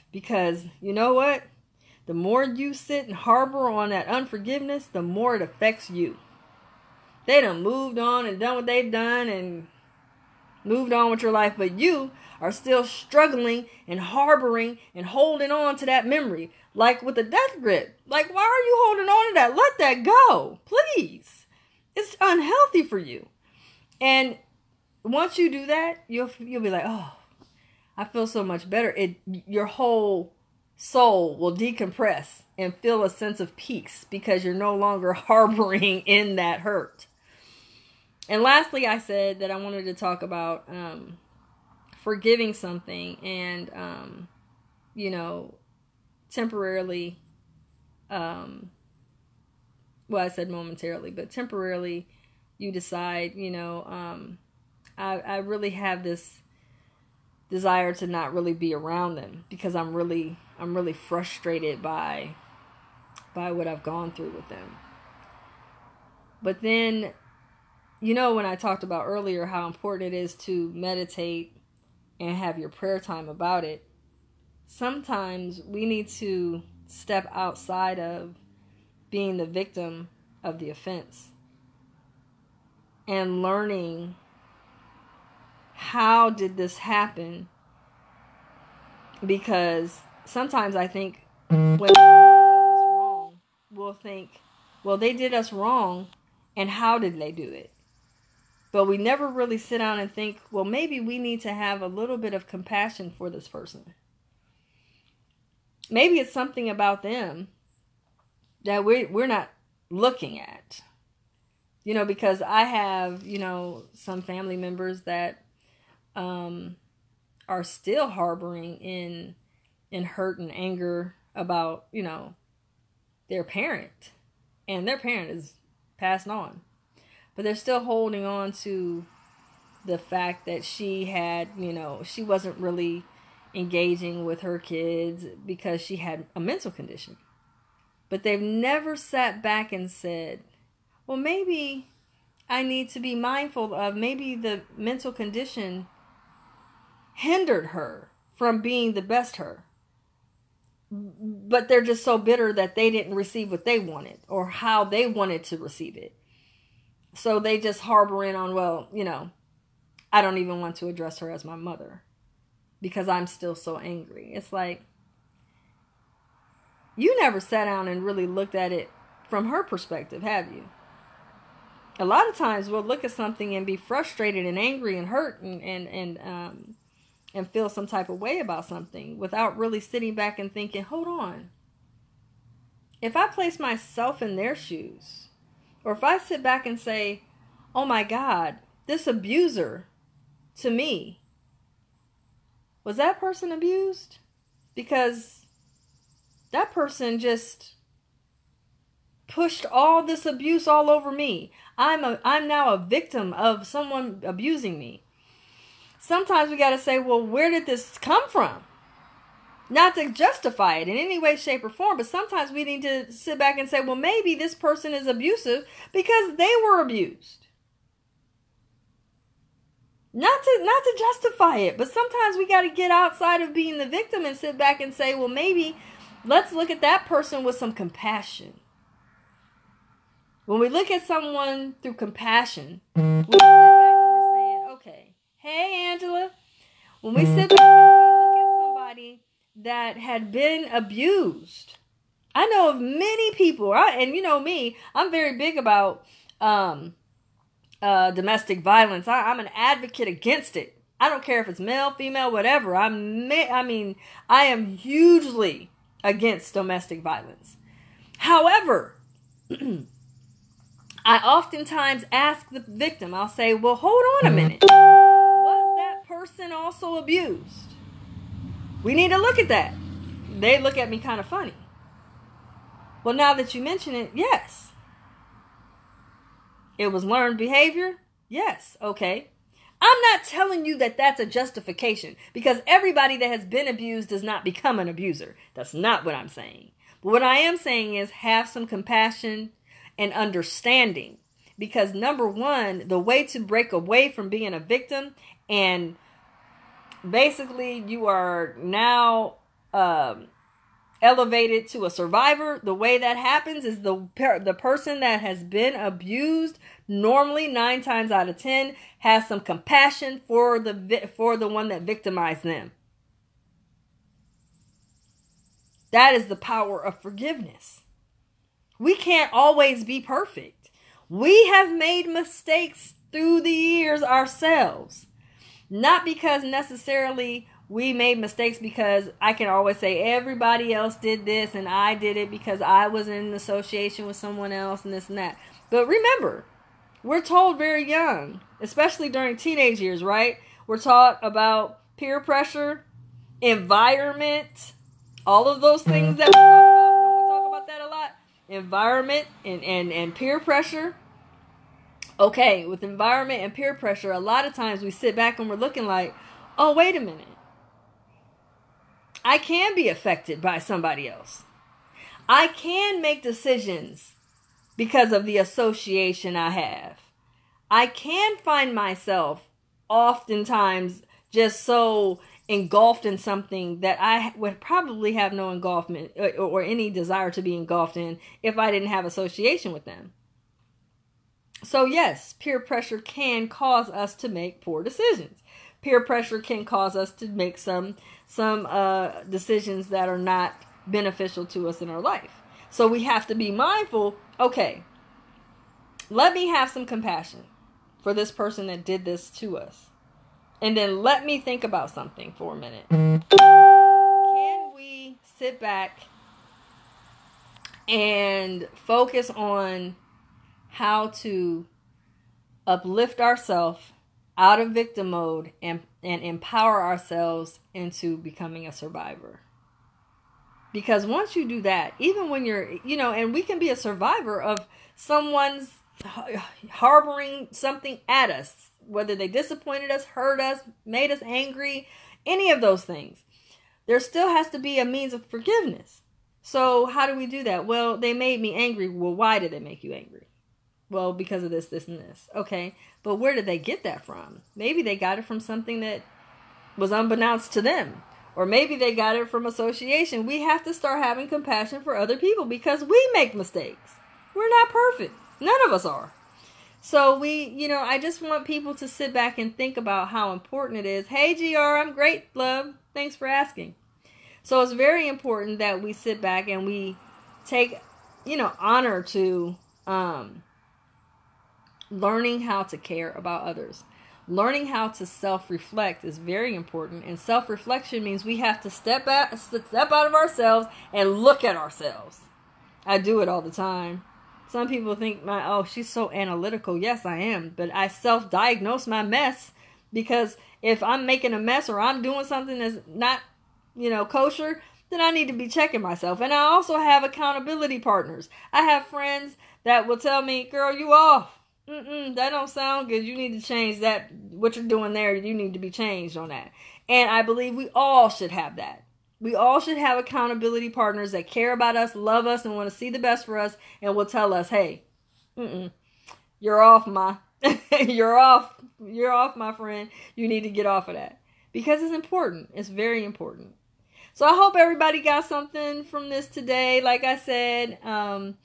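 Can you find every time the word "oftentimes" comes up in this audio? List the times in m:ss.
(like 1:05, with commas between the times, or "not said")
4:21, 6:09.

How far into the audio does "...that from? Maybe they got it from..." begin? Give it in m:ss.
7:23.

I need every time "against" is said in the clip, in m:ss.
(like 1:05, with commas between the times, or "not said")
4:10, 4:16.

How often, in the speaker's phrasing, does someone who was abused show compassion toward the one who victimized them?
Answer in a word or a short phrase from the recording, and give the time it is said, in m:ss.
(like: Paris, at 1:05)
9 times out of 10, at 5:07.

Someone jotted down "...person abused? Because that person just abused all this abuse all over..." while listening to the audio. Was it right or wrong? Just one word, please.
wrong.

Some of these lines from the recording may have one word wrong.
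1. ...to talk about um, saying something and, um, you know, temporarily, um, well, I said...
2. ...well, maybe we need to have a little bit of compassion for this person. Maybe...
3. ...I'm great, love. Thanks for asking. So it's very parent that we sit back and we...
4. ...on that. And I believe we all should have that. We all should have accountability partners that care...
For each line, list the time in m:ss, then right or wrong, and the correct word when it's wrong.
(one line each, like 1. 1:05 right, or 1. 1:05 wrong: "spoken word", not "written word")
1. 0:39 wrong: "forgiving", not "saying"
2. 1:40 right
3. 7:41 wrong: "important", not "parent"
4. 8:26 right.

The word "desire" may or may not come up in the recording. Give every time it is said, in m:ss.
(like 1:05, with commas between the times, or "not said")
0:57, 6:16.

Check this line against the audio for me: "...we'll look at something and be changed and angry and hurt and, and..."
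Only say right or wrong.
wrong.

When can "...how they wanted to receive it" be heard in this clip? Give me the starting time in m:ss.
2:34.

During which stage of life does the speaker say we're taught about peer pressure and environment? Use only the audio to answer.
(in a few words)
teenage years.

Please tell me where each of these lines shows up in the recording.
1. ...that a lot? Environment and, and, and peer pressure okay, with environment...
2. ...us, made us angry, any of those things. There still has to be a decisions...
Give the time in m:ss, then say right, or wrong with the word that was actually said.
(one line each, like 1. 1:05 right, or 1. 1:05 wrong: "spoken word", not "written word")
1. 5:47 right
2. 7:10 wrong: "means", not "decisions".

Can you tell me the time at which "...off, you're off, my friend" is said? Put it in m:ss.
8:38.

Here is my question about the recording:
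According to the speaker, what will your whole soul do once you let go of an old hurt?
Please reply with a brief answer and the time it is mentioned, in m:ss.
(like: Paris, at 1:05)
decompress, at 0:31.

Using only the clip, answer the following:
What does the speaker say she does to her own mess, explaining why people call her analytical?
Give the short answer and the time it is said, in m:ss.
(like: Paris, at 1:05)
self-diagnose, at 8:07.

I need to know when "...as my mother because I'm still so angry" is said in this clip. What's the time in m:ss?
2:41.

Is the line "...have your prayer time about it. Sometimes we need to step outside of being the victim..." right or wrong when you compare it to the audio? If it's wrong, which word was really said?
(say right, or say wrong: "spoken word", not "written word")
right.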